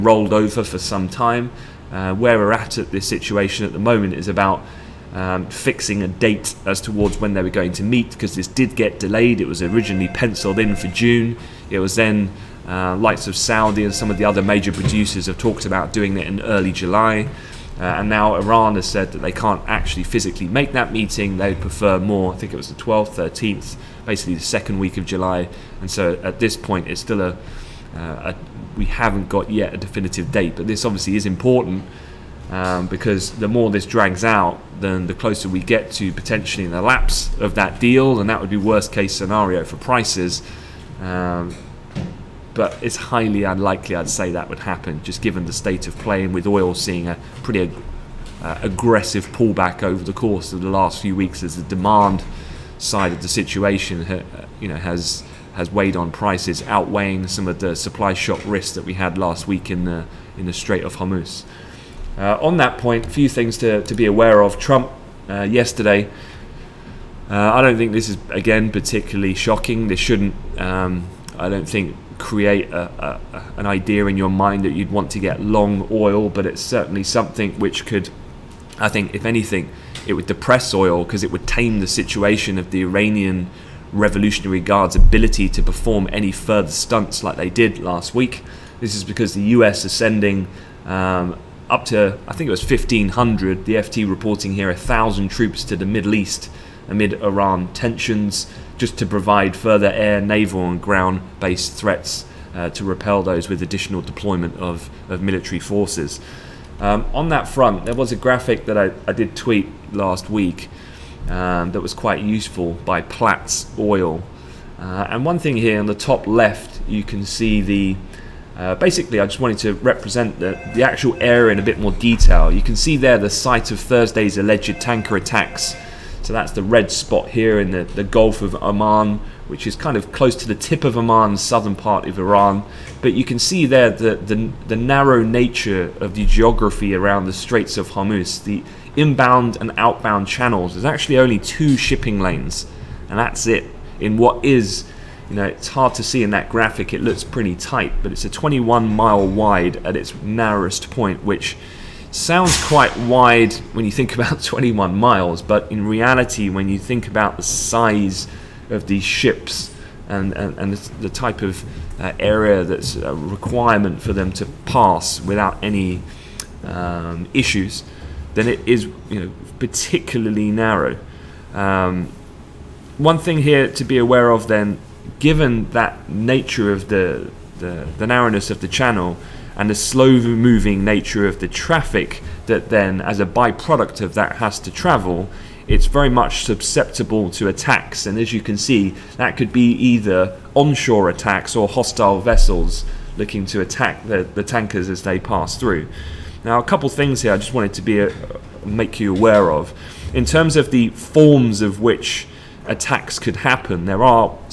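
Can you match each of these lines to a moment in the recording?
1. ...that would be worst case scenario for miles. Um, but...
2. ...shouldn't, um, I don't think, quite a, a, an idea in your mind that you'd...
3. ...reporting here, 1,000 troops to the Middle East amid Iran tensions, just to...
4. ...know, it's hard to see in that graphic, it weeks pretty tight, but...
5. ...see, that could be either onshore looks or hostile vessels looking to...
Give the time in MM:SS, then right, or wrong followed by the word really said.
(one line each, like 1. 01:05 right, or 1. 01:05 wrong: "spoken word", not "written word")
1. 00:38 wrong: "prices", not "miles"
2. 01:09 wrong: "create", not "quite"
3. 01:34 right
4. 02:25 wrong: "looks", not "weeks"
5. 03:08 wrong: "attacks", not "looks".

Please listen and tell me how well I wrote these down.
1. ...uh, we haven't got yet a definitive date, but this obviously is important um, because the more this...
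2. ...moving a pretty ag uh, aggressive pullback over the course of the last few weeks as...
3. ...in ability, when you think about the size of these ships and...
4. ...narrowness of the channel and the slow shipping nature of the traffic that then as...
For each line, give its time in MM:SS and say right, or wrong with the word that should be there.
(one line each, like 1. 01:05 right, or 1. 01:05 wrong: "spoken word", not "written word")
1. 00:27 right
2. 00:46 wrong: "seeing", not "moving"
3. 02:35 wrong: "reality", not "ability"
4. 02:58 wrong: "moving", not "shipping".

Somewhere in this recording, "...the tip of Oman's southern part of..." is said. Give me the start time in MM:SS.
02:10.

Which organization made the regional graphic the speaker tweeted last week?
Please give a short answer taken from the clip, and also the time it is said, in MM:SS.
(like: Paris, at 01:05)
Platts Oil, at 01:53.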